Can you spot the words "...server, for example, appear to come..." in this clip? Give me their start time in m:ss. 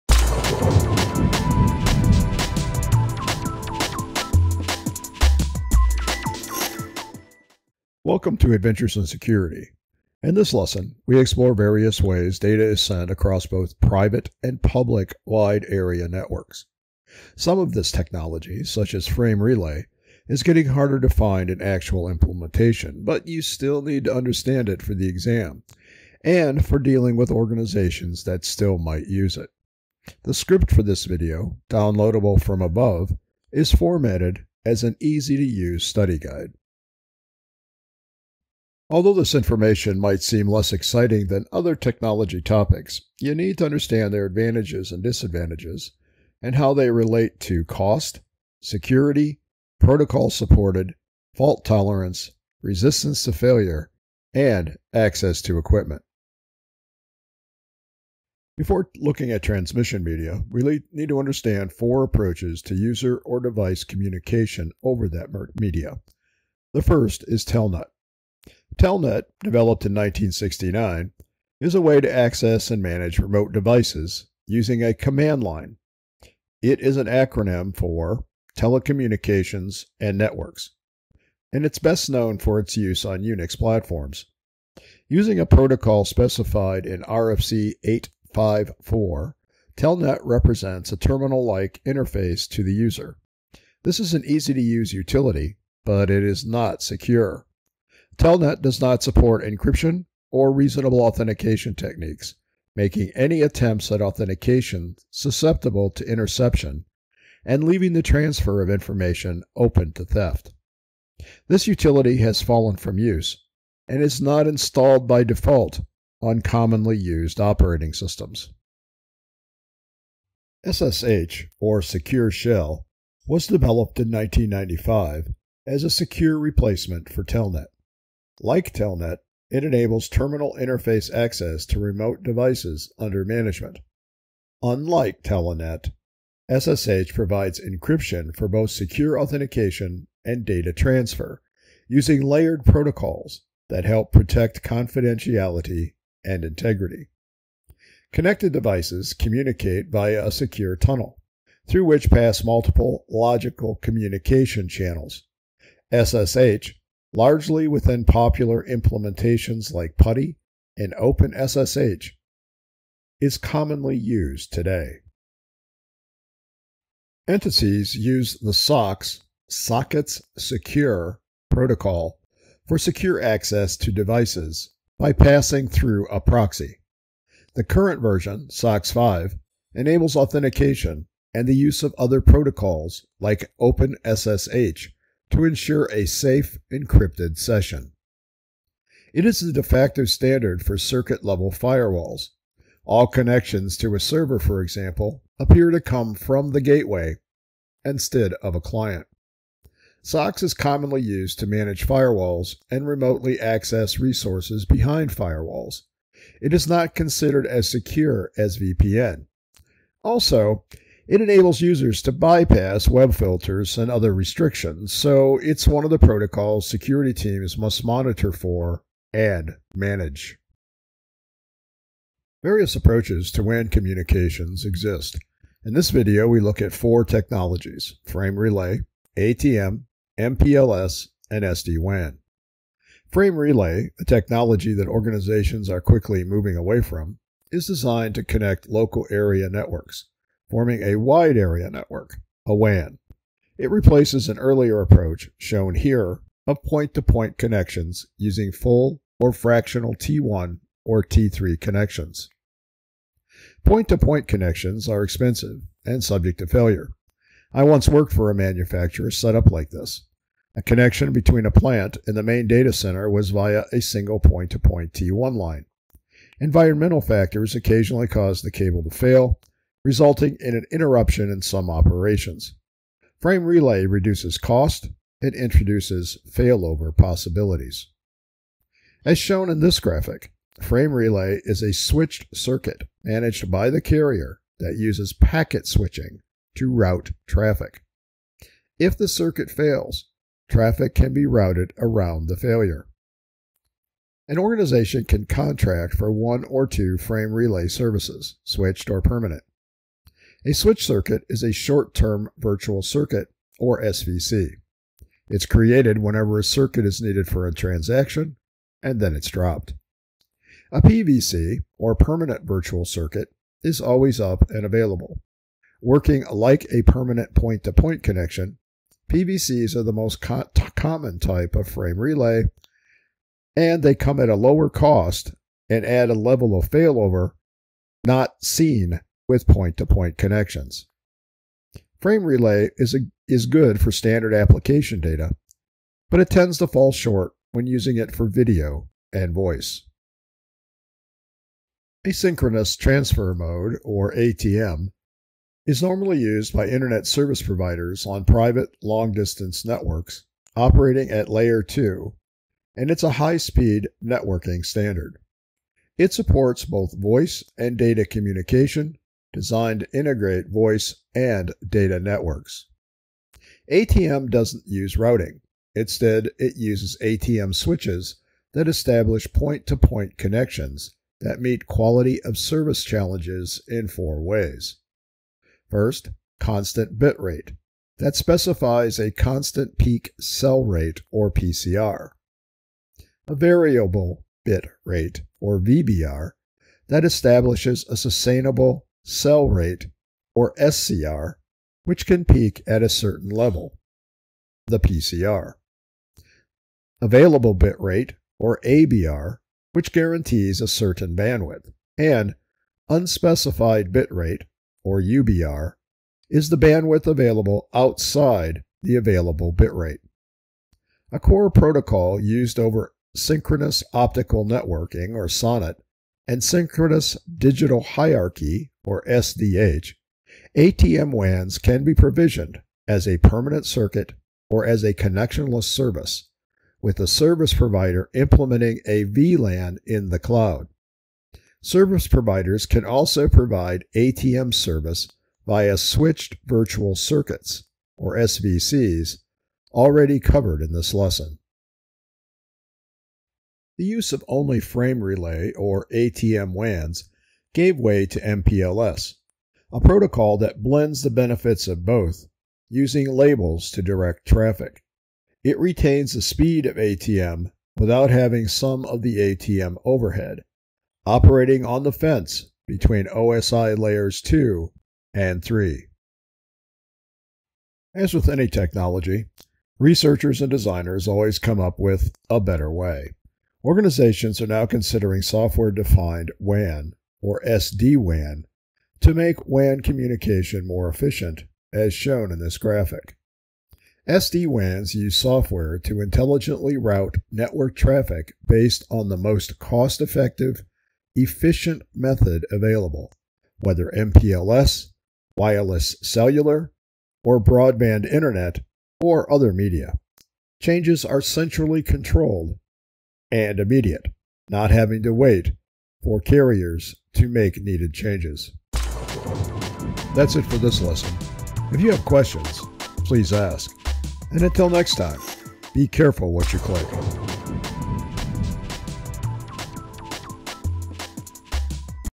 3:13.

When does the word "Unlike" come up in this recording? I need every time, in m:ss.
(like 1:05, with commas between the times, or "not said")
2:14.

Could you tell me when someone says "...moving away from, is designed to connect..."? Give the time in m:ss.
3:56.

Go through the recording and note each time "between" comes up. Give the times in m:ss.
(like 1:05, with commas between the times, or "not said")
4:21, 7:42.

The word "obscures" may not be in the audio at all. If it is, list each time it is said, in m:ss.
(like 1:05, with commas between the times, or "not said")
not said.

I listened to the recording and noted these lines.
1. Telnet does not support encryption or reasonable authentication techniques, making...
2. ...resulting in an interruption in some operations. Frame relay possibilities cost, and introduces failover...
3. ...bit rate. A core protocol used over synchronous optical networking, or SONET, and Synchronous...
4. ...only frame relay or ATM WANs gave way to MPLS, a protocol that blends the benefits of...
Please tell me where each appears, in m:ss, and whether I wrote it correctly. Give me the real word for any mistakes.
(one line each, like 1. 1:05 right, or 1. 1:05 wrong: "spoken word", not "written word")
1. 1:38 right
2. 4:29 wrong: "reduces", not "possibilities"
3. 6:49 right
4. 7:24 right.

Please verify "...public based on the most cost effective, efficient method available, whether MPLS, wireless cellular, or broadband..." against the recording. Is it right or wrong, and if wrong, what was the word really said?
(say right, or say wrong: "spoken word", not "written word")
wrong: "traffic", not "public".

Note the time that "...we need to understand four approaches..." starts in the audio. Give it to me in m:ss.
1:00.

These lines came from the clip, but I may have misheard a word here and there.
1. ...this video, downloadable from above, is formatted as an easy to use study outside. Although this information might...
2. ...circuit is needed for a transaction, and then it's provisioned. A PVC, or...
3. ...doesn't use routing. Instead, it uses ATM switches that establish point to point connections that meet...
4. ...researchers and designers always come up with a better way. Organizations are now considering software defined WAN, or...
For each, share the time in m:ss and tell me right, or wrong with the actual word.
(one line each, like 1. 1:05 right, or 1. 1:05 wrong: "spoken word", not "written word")
1. 0:30 wrong: "guide", not "outside"
2. 5:06 wrong: "dropped", not "provisioned"
3. 6:04 right
4. 7:49 right.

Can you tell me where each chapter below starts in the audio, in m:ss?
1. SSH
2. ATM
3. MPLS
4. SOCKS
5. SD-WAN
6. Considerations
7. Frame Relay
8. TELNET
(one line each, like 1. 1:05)
1. 1:59
2. 5:40
3. 7:23
4. 2:46
5. 7:47
6. 0:38
7. 3:53
8. 1:08.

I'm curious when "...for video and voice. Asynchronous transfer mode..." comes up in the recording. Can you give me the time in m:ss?
5:38.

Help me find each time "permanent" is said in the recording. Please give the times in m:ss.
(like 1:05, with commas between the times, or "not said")
4:59, 5:11, 5:16, 7:03.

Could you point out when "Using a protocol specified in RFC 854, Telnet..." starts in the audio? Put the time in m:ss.
1:25.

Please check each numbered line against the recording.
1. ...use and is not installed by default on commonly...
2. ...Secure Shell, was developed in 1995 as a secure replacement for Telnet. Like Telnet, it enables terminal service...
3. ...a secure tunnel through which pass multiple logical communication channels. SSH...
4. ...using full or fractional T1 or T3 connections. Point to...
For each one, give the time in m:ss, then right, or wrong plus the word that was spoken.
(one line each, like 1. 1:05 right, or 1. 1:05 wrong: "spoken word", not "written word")
1. 1:52 right
2. 2:01 wrong: "interface", not "service"
3. 2:30 right
4. 4:08 right.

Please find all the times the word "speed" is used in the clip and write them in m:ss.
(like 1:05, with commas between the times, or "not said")
5:53, 7:36.